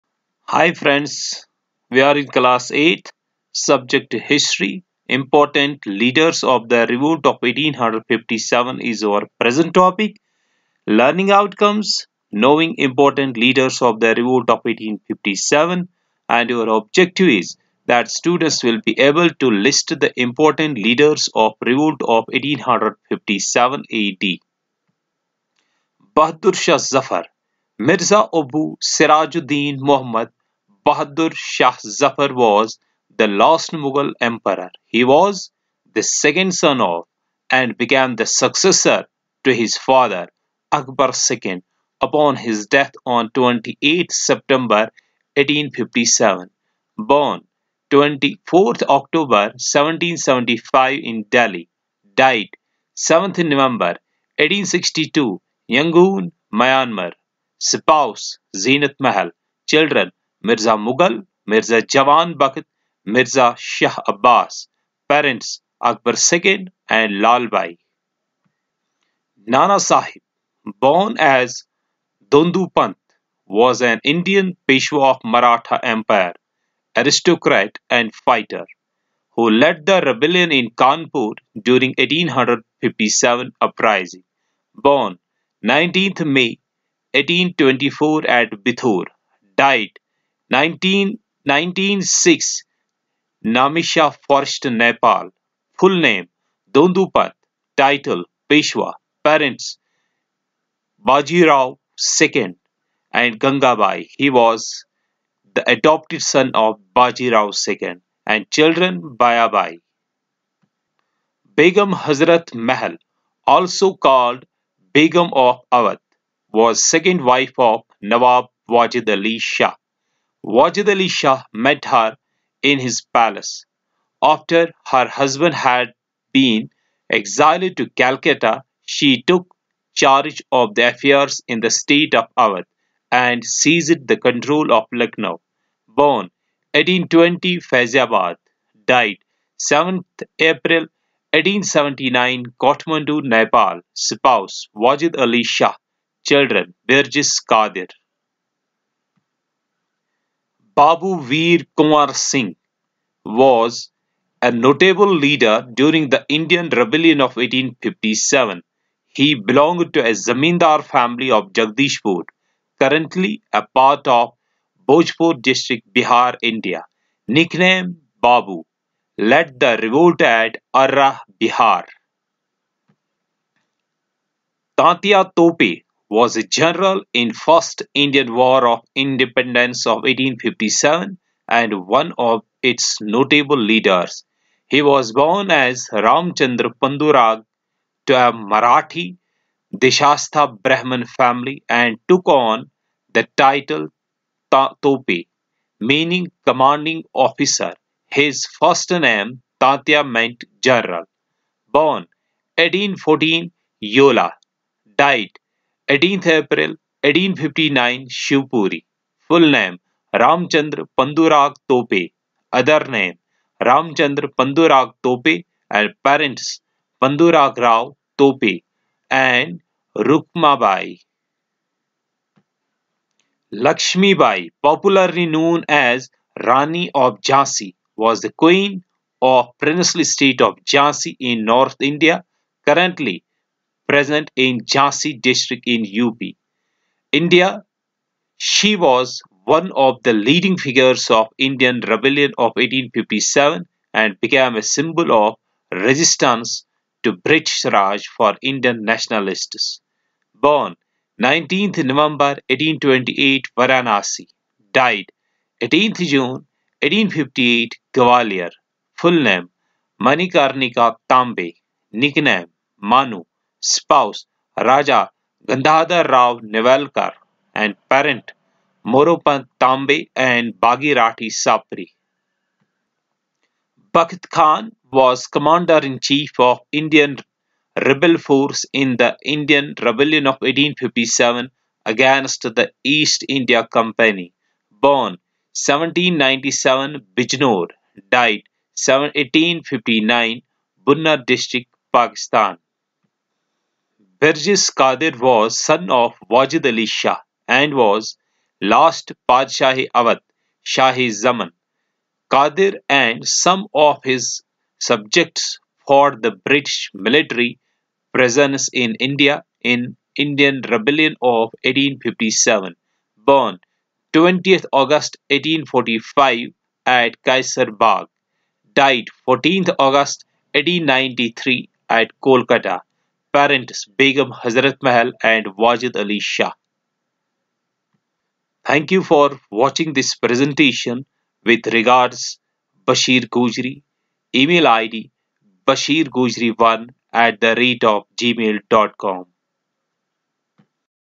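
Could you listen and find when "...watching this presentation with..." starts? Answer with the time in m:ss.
5:29.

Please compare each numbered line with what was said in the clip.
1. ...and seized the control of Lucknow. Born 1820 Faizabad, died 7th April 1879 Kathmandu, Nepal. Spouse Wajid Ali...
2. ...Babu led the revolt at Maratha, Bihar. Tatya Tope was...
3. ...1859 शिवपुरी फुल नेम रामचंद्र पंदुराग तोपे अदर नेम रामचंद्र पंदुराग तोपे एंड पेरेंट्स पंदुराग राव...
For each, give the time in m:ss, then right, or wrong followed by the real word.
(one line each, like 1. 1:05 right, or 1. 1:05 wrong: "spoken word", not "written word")
1. 2:13 right
2. 2:48 wrong: "Arrah", not "Maratha"
3. 3:27 right.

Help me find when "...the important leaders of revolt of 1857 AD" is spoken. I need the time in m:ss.
0:20.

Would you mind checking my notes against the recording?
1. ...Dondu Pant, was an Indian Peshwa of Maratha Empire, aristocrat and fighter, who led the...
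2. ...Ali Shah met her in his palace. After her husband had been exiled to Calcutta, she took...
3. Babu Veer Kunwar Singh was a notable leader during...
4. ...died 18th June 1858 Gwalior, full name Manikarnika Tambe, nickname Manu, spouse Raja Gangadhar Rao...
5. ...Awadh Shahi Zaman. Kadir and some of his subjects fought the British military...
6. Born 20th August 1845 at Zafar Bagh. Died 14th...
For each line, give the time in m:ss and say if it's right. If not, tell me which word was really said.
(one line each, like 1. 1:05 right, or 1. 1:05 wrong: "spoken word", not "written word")
1. 1:12 right
2. 2:00 right
3. 2:30 right
4. 4:14 right
5. 4:59 right
6. 5:13 wrong: "Kaiser", not "Zafar".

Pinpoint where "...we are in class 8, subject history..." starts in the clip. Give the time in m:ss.
0:01.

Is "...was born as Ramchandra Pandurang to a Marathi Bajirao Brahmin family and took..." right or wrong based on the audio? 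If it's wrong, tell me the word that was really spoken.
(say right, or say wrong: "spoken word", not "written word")
wrong: "Deshastha", not "Bajirao".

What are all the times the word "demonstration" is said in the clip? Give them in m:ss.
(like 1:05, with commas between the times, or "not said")
not said.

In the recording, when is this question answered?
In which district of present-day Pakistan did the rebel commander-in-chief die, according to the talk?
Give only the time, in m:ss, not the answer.
4:50.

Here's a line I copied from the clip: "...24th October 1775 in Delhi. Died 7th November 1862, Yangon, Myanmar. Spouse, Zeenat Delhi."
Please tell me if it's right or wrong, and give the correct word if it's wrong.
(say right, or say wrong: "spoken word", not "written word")
wrong: "Mahal", not "Delhi".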